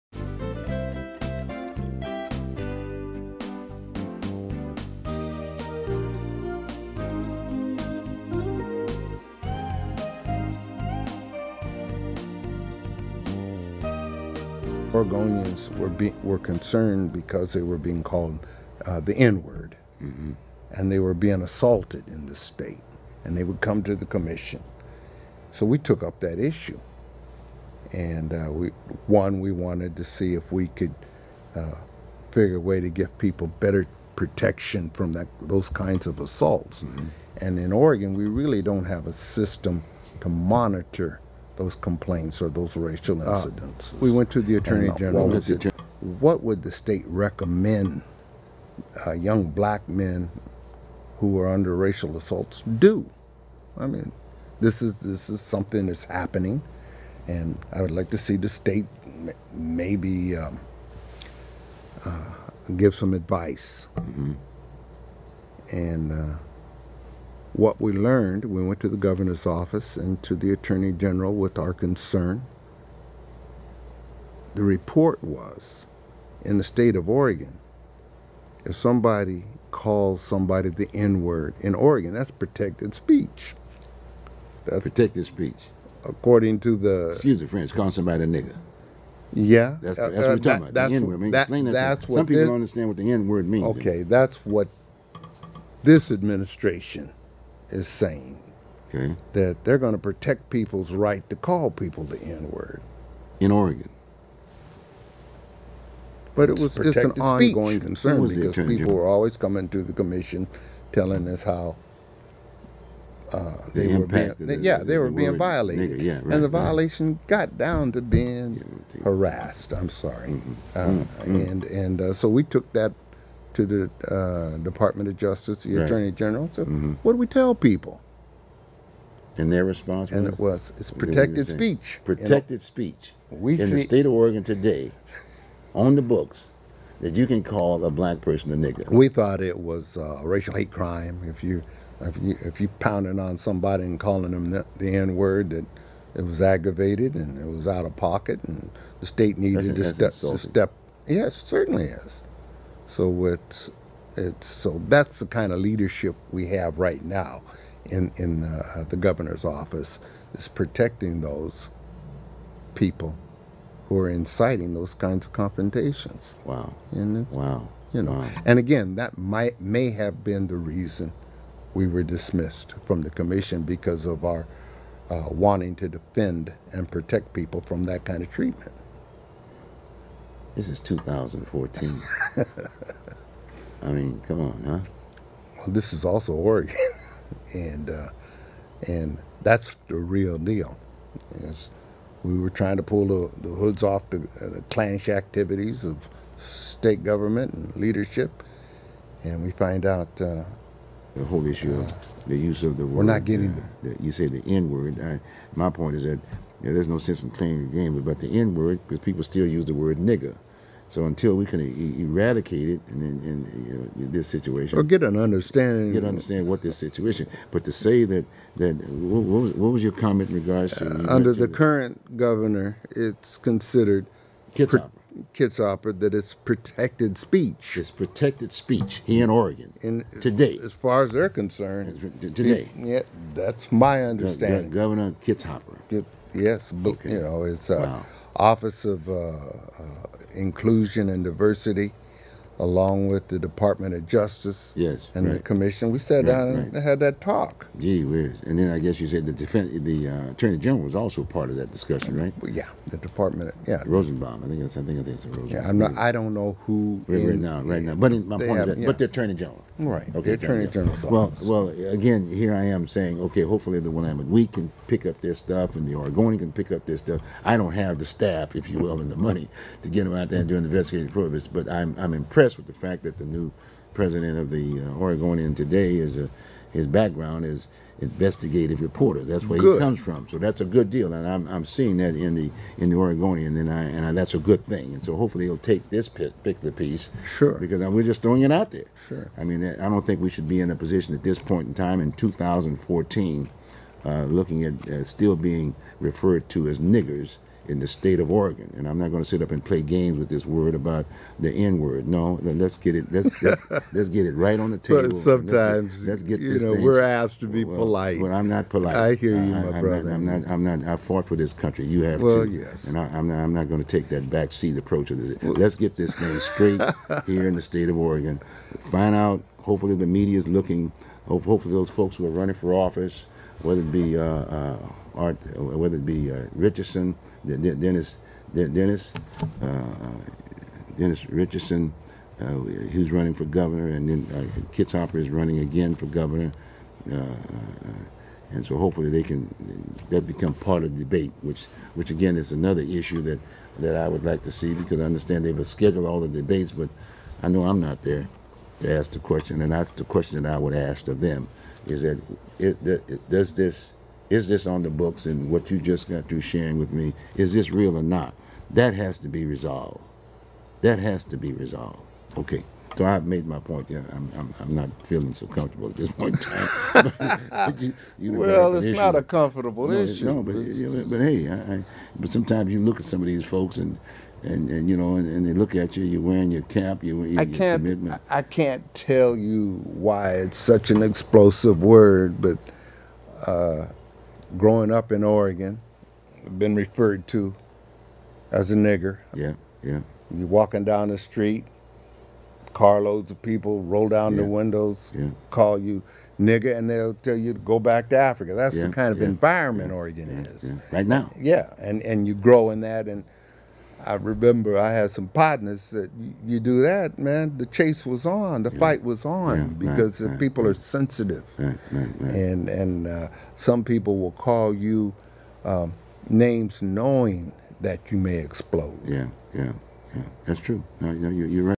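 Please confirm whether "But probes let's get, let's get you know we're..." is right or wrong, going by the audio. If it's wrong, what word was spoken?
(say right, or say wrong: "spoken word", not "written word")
wrong: "sometimes", not "probes".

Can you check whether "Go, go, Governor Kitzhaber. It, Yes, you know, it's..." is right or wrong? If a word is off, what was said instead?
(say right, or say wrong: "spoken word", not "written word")
right.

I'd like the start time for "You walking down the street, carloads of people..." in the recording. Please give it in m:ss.
6:30.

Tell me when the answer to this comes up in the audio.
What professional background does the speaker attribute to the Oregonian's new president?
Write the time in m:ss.
4:37.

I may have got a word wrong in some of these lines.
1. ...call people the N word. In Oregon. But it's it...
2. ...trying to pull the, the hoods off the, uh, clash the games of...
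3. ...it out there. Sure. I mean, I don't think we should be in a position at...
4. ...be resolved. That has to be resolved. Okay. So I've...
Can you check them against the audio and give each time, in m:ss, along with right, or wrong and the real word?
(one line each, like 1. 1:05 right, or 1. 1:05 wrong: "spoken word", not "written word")
1. 1:41 right
2. 3:12 wrong: "activities", not "games"
3. 4:48 right
4. 5:59 right.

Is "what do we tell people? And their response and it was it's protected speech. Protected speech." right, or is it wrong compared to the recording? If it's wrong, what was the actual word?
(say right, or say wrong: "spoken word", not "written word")
right.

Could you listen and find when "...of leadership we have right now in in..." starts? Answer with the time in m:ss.
2:35.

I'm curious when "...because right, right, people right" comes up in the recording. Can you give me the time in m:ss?
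6:49.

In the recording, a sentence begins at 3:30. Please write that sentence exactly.
So until we can e eradicate it in, in, in, in, this situation, or get an understanding, get understand what this situation.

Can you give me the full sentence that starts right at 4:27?
I don't have the staff, if you will, and the money to get them out there and do an investigative probes.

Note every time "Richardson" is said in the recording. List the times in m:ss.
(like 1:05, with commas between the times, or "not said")
5:26, 5:31.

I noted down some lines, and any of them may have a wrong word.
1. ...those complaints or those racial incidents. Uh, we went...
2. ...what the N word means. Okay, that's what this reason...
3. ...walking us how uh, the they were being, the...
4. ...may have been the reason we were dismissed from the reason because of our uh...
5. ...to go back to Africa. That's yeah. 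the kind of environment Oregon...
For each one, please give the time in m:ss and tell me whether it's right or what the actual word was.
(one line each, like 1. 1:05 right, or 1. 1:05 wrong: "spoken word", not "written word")
1. 0:41 right
2. 1:32 wrong: "administration", not "reason"
3. 1:50 wrong: "telling", not "walking"
4. 2:49 wrong: "commission", not "reason"
5. 6:37 right.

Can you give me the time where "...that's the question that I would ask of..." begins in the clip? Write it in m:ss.
5:49.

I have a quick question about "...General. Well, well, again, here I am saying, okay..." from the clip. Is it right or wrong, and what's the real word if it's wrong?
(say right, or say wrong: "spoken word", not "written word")
right.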